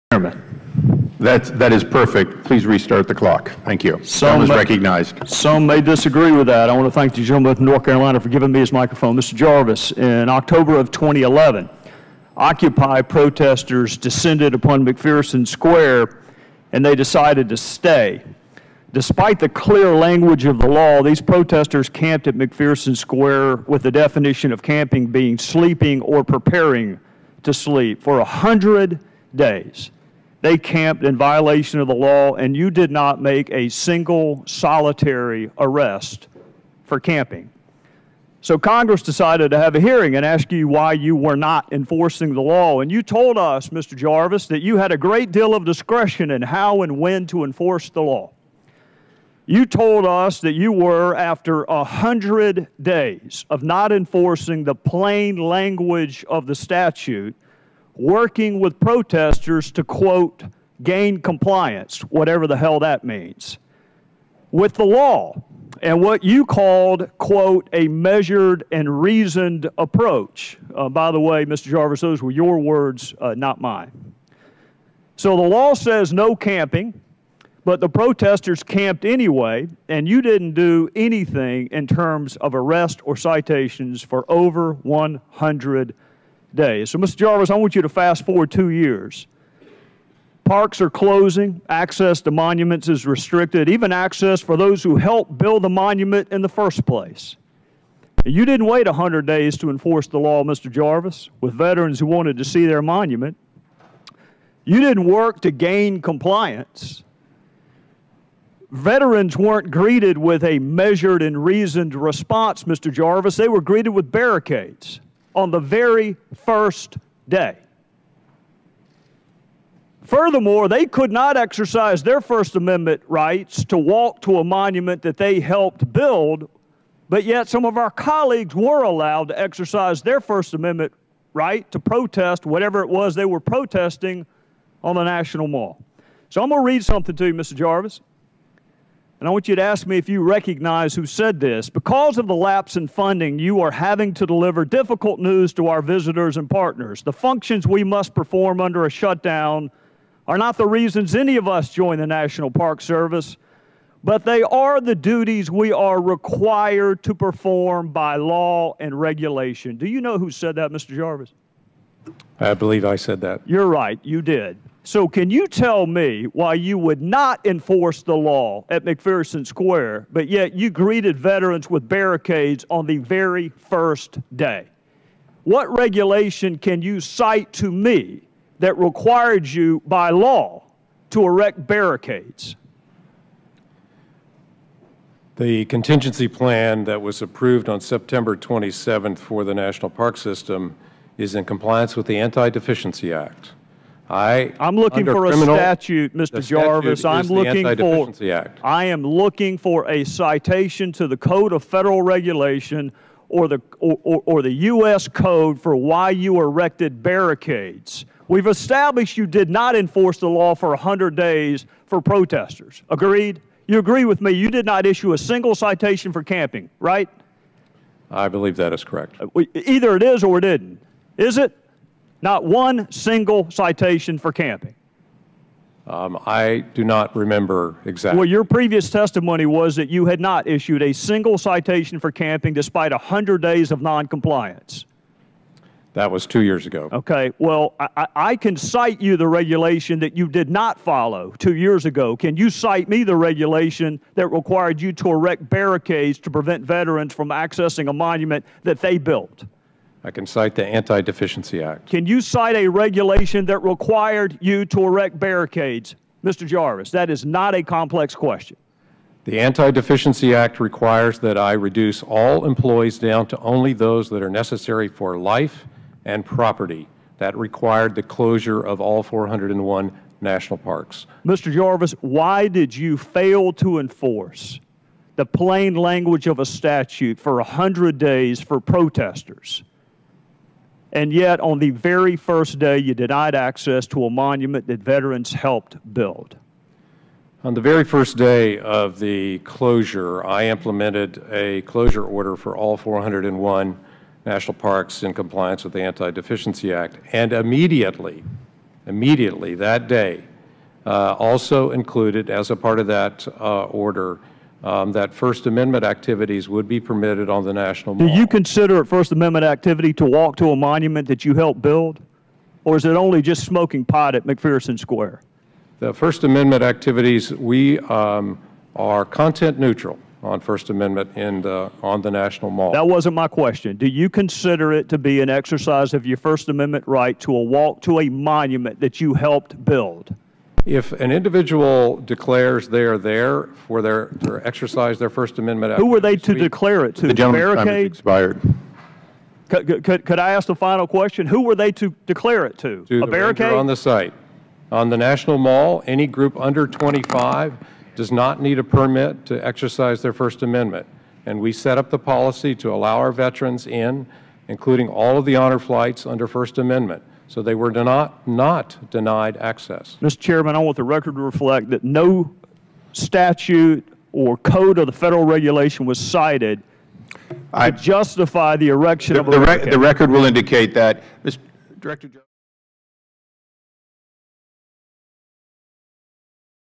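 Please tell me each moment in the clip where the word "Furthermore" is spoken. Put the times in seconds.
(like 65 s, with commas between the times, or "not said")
120 s.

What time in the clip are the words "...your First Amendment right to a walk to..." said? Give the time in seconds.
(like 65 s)
326 s.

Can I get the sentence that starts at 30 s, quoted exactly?
They camped in violation of the law, and you did not make a single solitary arrest for camping.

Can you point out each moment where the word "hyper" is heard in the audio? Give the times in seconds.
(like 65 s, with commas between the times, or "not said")
not said.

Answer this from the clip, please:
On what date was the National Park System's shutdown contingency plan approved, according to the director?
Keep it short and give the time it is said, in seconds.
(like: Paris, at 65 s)
September 27th, at 187 s.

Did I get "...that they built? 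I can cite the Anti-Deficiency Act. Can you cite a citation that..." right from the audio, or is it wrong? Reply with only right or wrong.
wrong.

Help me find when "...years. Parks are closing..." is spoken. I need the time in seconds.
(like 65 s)
88 s.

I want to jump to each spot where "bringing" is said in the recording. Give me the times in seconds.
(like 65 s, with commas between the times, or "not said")
not said.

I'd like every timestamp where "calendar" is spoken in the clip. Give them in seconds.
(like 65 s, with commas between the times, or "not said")
not said.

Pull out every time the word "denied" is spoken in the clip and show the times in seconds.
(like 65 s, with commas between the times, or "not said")
282 s, 358 s.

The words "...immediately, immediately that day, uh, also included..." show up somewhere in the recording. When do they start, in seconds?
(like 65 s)
297 s.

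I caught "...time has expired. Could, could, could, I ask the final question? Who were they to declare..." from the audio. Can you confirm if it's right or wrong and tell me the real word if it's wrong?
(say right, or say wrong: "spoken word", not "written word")
right.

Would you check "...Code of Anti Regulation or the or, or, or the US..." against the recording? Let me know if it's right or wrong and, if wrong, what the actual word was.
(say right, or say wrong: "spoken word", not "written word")
wrong: "Federal", not "Anti".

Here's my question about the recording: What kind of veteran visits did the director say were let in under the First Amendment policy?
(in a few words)
honor flights.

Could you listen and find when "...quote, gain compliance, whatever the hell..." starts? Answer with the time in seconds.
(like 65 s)
59 s.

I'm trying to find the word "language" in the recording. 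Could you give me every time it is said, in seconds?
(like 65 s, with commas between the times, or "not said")
19 s, 55 s, 275 s.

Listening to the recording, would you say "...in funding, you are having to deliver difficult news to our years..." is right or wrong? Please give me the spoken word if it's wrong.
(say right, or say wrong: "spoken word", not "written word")
wrong: "visitors", not "years".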